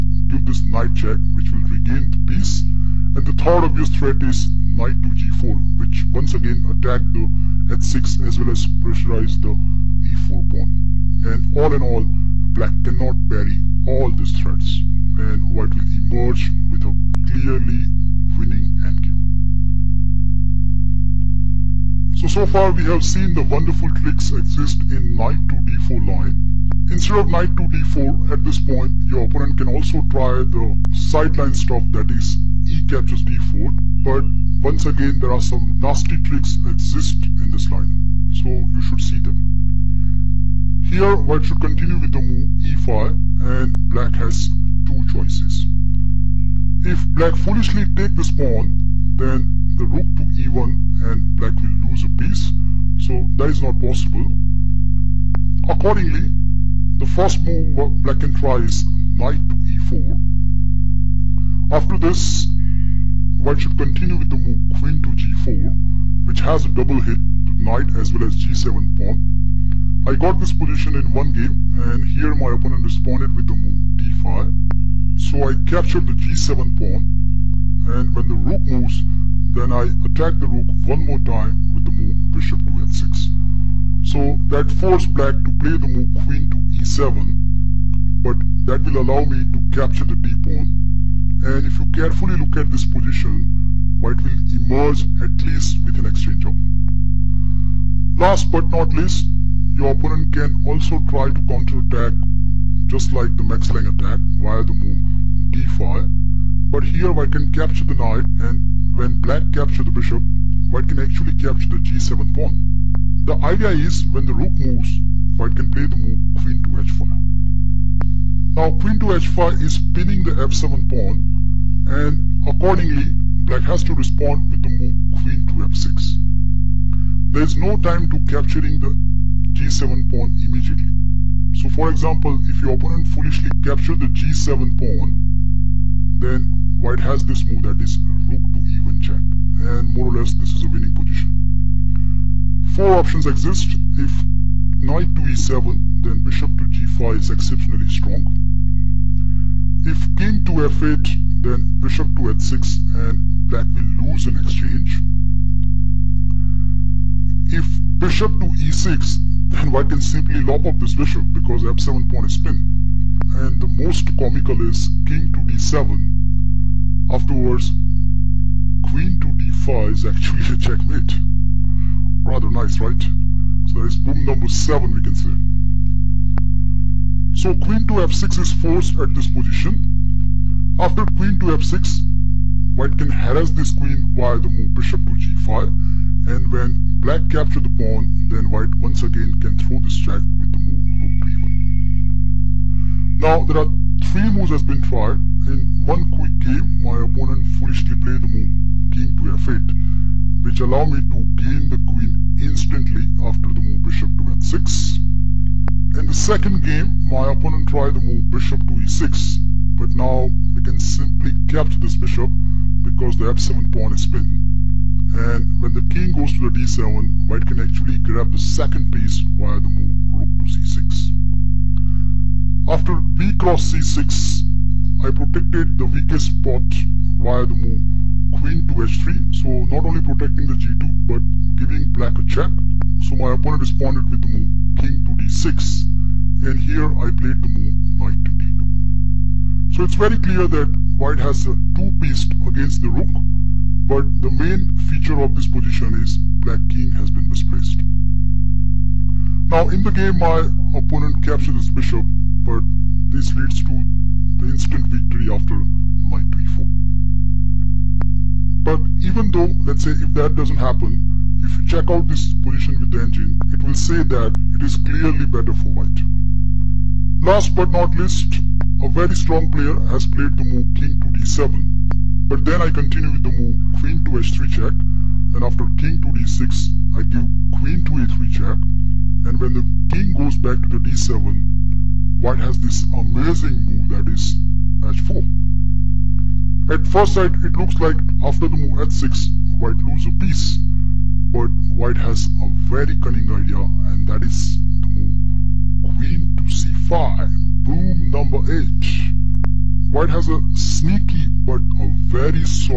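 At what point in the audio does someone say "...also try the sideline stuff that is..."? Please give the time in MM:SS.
00:29.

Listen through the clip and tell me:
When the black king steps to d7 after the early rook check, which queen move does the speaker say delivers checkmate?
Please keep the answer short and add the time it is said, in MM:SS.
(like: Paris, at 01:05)
Queen to d5, at 02:48.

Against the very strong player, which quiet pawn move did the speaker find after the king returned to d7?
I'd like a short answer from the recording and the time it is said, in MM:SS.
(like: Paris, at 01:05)
h4, at 04:44.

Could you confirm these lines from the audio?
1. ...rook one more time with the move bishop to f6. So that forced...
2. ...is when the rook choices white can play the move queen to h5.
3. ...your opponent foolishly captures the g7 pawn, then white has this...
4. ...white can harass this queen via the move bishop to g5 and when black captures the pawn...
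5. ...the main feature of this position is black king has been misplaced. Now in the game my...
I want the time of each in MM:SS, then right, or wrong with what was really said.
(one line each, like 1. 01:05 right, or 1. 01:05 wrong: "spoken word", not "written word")
1. 01:20 right
2. 01:53 wrong: "moves", not "choices"
3. 02:12 right
4. 03:02 right
5. 04:04 right.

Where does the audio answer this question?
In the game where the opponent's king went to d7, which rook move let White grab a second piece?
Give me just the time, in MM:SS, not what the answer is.
03:40.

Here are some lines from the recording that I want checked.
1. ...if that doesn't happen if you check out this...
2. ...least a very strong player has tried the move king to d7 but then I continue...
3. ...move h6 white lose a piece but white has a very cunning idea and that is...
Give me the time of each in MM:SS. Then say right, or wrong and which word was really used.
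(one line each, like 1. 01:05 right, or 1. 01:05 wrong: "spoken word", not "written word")
1. 04:19 right
2. 04:27 wrong: "played", not "tried"
3. 04:48 right.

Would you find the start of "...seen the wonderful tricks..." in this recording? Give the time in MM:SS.
00:23.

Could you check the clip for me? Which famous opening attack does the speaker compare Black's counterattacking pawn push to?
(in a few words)
Max Lange attack.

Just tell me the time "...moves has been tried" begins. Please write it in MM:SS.
03:14.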